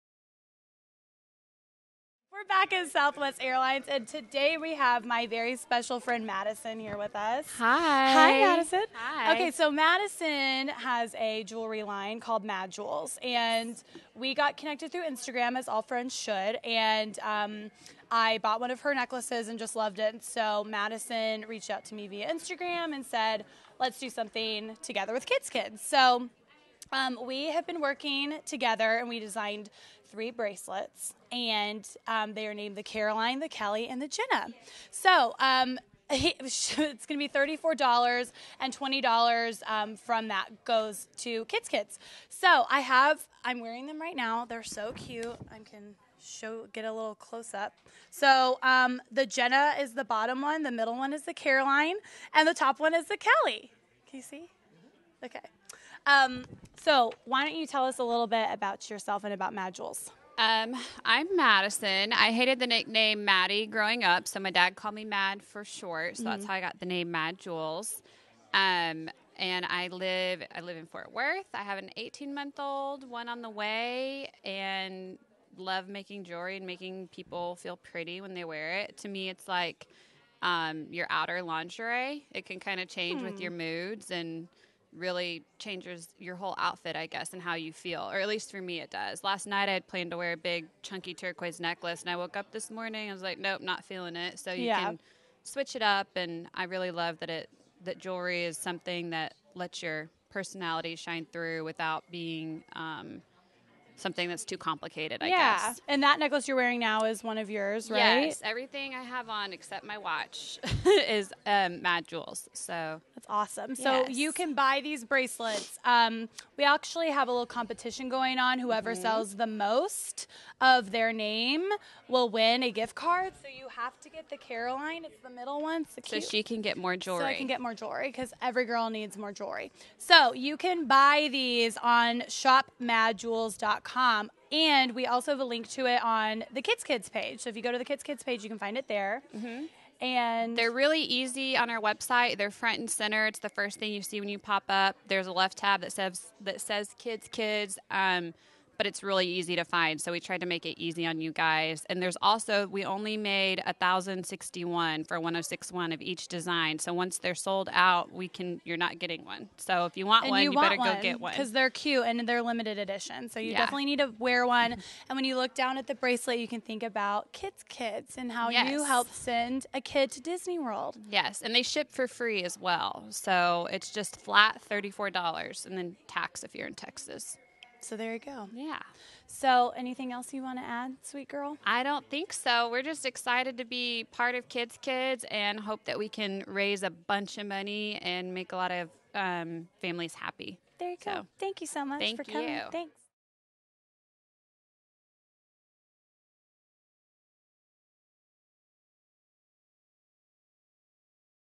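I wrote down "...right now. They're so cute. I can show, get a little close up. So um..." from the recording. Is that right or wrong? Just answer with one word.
right.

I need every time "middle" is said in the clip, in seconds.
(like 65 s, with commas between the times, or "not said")
50 s, 125 s.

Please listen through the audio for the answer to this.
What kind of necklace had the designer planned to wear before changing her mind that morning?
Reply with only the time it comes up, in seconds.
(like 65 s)
90 s.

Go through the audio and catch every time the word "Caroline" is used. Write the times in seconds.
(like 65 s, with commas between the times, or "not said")
32 s, 51 s, 124 s.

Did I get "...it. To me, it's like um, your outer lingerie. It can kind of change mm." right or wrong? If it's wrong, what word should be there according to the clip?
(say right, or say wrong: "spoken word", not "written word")
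right.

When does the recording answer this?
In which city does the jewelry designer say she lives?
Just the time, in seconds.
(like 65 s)
70 s.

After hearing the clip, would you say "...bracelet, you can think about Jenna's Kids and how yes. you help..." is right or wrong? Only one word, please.
wrong.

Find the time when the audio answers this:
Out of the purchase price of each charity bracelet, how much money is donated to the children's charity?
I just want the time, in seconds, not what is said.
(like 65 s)
38 s.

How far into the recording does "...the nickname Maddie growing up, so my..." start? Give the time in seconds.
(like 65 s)
62 s.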